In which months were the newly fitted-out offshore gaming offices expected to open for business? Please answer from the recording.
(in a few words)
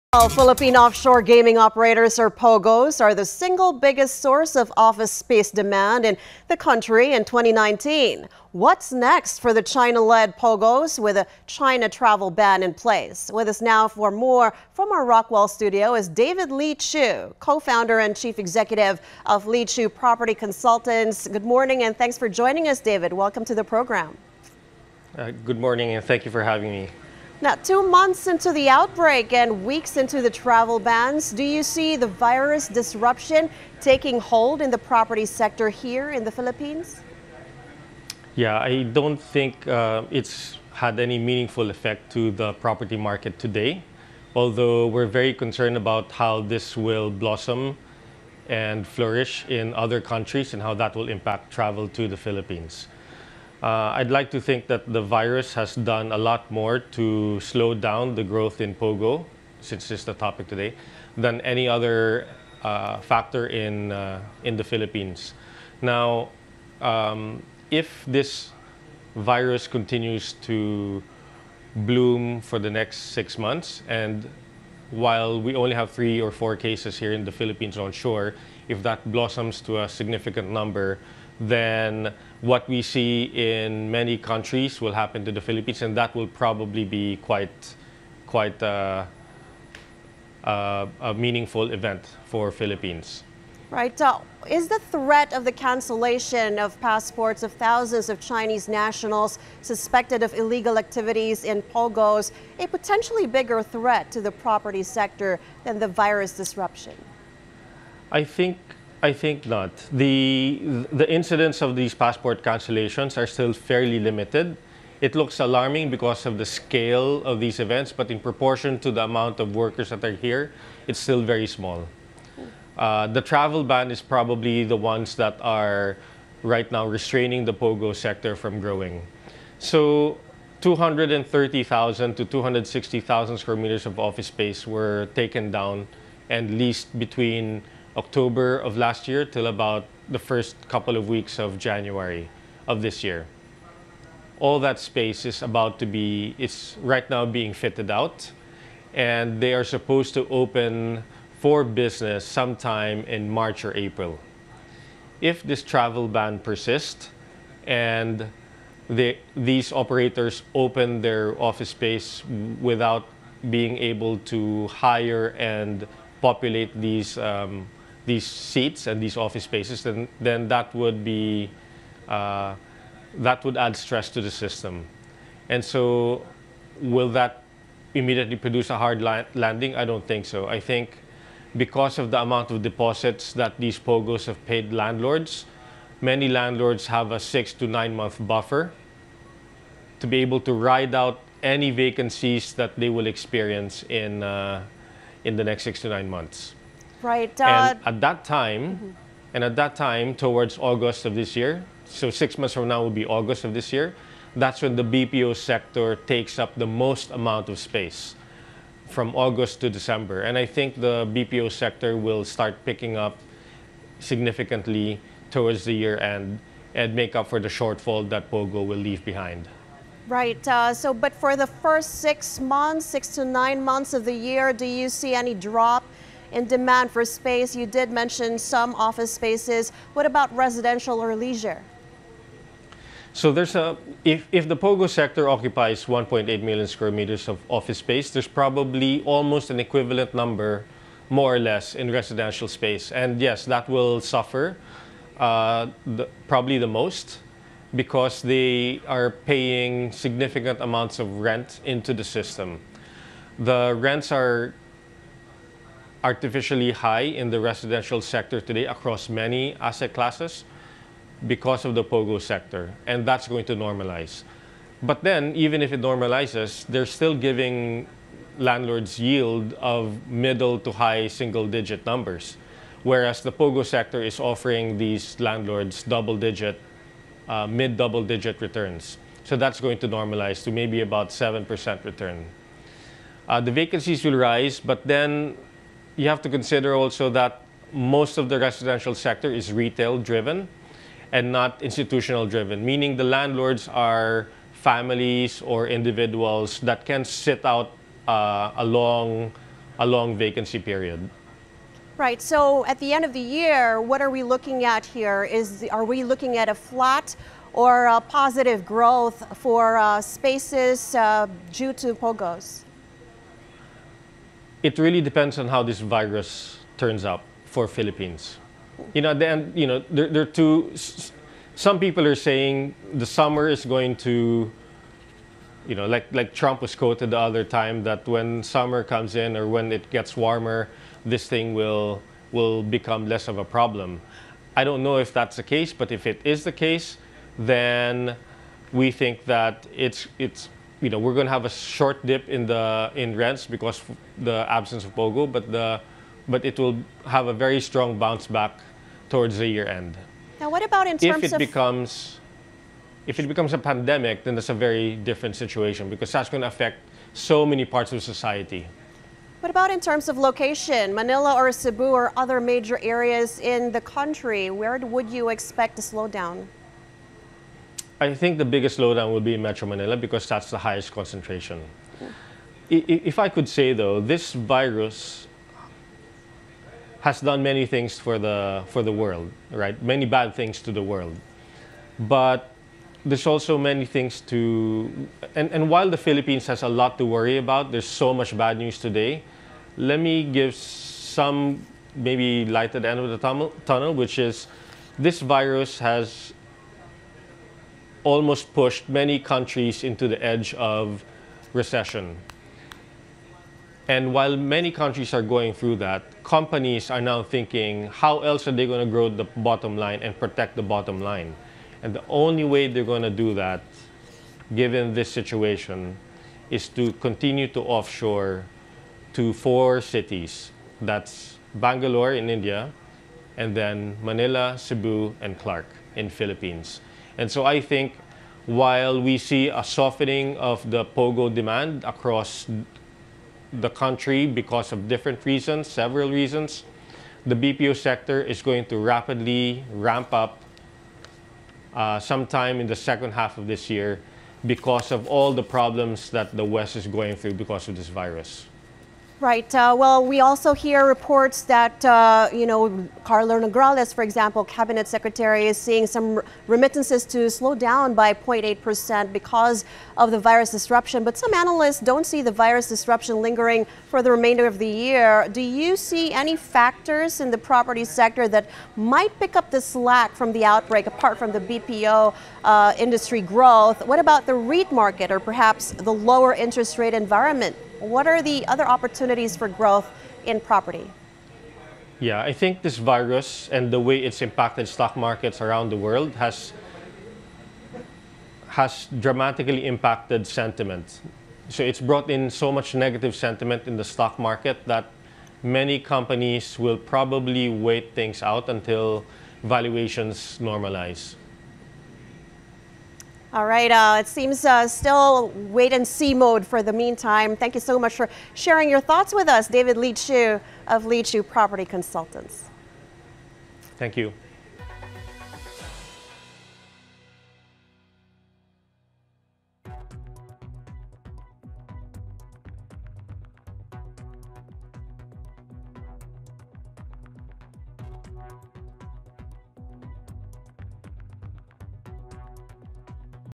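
March or April.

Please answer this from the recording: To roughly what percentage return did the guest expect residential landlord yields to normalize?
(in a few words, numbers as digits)
7%.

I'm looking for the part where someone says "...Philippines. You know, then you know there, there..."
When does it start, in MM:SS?
05:17.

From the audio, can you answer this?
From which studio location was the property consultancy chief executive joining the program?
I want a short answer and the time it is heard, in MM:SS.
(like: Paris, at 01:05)
Rockwell, at 00:15.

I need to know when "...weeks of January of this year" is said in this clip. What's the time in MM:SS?
02:21.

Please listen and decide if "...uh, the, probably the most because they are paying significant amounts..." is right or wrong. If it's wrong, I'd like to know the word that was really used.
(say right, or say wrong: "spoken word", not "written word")
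right.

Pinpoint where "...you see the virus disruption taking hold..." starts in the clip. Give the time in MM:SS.
00:31.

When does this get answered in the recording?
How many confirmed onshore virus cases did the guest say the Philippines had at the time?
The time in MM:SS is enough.
01:15.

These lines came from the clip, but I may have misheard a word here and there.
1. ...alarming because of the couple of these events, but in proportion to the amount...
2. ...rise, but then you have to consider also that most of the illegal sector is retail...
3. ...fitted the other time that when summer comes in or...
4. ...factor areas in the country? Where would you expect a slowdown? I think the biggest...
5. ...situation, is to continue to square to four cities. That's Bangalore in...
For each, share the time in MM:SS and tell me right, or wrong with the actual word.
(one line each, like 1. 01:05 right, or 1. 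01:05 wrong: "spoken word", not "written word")
1. 01:55 wrong: "scale", not "couple"
2. 04:44 wrong: "residential", not "illegal"
3. 05:26 wrong: "quoted", not "fitted"
4. 06:02 wrong: "major", not "factor"
5. 06:55 wrong: "offshore", not "square".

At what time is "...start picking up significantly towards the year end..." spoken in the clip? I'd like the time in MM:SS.
03:32.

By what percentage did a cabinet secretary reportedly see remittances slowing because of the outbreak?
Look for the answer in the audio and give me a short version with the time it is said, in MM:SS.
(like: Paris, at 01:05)
0.8%, at 07:38.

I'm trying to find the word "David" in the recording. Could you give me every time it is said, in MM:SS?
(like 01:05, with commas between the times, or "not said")
00:16, 00:22, 08:29.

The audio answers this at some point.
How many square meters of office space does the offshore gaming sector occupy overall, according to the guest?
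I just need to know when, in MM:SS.
03:55.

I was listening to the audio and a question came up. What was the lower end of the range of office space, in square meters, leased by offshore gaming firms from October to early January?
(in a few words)
230,000.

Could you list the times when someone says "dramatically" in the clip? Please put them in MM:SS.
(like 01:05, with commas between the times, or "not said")
08:08.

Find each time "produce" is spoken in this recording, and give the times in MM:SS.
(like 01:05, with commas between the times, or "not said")
02:58.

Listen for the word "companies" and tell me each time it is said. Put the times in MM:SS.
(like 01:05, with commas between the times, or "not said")
06:46, 08:15.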